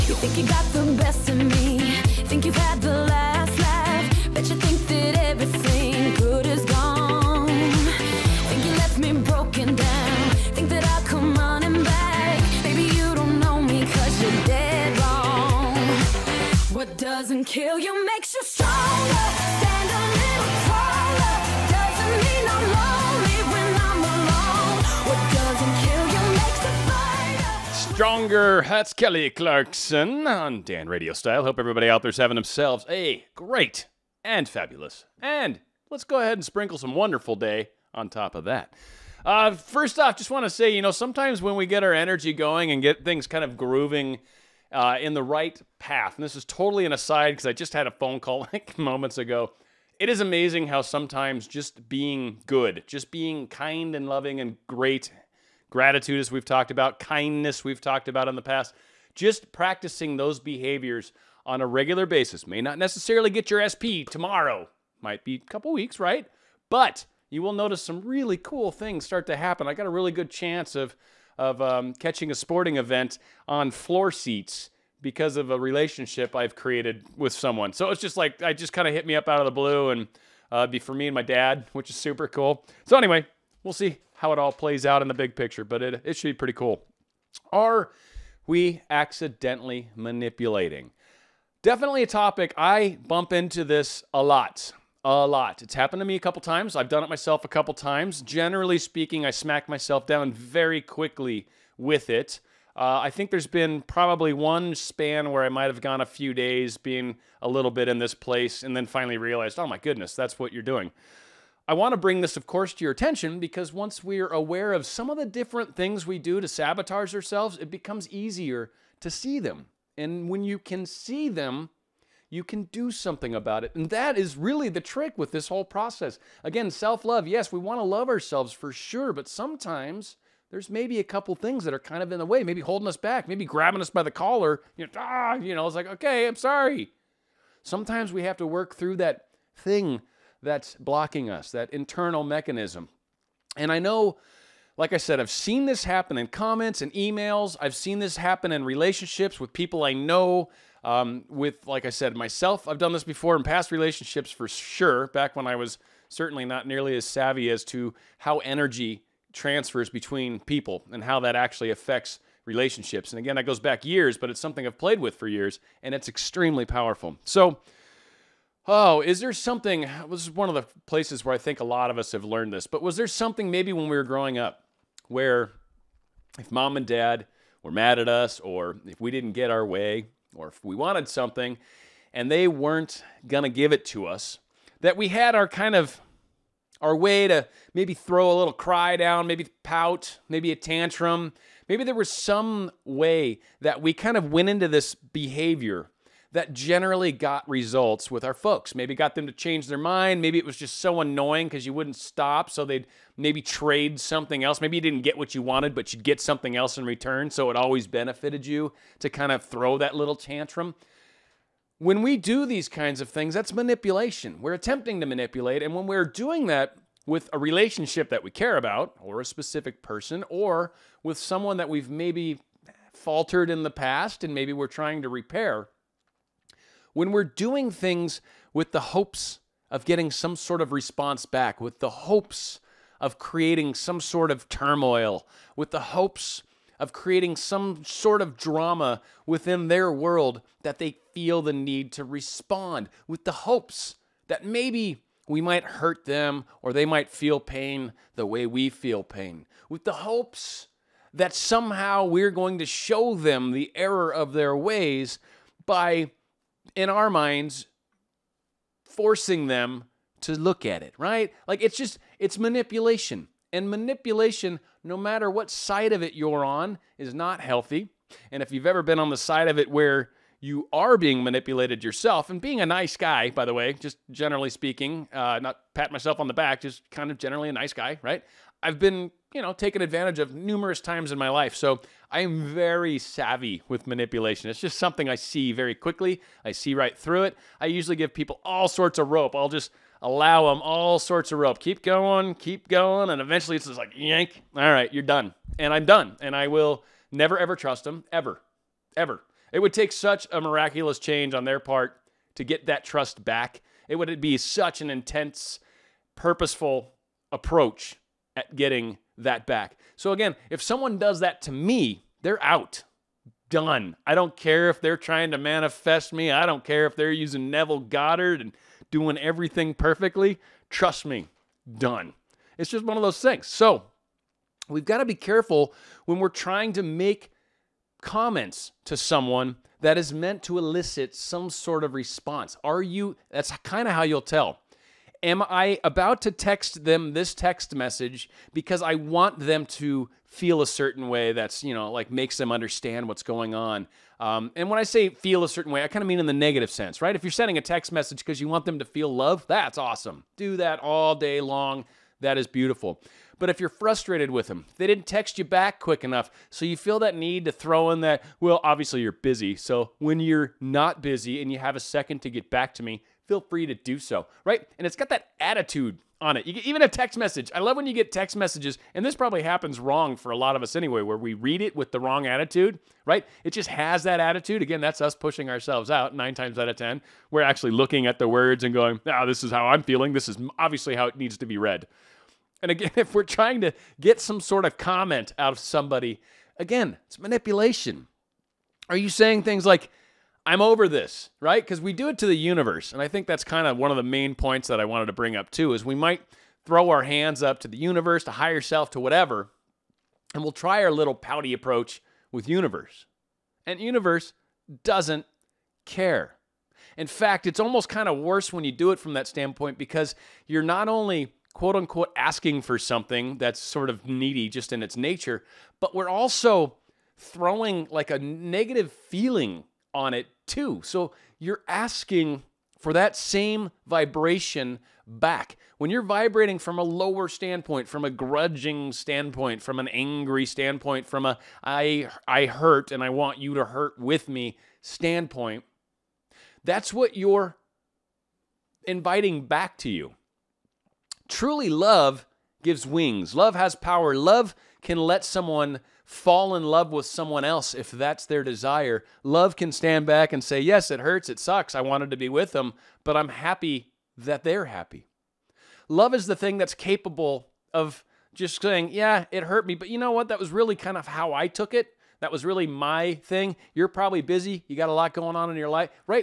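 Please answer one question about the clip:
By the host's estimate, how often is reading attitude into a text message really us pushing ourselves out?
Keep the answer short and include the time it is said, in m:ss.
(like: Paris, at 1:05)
9 times out of 10, at 6:16.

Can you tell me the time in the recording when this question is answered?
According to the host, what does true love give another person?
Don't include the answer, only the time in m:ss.
7:22.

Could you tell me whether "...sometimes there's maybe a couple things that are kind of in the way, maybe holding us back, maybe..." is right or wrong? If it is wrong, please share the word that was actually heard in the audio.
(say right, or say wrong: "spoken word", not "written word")
right.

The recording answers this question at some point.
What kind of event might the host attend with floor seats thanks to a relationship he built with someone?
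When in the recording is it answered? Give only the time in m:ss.
1:12.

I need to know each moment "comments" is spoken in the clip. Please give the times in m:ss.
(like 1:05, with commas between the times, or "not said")
2:26, 5:28, 6:24.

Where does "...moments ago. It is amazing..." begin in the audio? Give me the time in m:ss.
0:48.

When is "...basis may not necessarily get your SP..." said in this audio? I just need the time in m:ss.
1:02.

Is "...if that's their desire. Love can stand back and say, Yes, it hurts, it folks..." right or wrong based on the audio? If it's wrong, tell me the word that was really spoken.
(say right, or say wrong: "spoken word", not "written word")
wrong: "sucks", not "folks".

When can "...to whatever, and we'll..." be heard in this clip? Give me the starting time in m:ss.
6:38.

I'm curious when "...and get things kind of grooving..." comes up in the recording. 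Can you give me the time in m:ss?
0:42.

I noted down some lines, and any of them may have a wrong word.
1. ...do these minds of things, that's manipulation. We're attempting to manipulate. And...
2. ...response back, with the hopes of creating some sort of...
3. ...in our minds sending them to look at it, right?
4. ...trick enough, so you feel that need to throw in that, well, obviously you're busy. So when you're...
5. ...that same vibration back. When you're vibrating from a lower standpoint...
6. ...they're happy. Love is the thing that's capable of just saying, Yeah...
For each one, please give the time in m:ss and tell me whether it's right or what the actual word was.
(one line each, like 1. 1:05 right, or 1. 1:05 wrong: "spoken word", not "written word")
1. 3:32 wrong: "kinds", not "minds"
2. 3:50 right
3. 4:16 wrong: "forcing", not "sending"
4. 5:55 wrong: "quick", not "trick"
5. 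7:02 right
6. 7:34 right.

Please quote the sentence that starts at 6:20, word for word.
This is obviously how it needs to be read.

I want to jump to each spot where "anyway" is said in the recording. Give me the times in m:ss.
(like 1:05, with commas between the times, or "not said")
1:22, 6:10.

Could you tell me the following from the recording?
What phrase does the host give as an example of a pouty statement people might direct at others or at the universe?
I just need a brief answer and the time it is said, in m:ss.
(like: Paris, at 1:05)
I'm over this, at 6:30.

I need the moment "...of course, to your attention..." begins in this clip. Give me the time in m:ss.
1:52.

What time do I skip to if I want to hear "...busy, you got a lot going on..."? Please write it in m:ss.
7:44.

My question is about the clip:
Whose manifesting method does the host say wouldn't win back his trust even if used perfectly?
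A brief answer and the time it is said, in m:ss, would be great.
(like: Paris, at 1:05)
Neville Goddard, at 5:17.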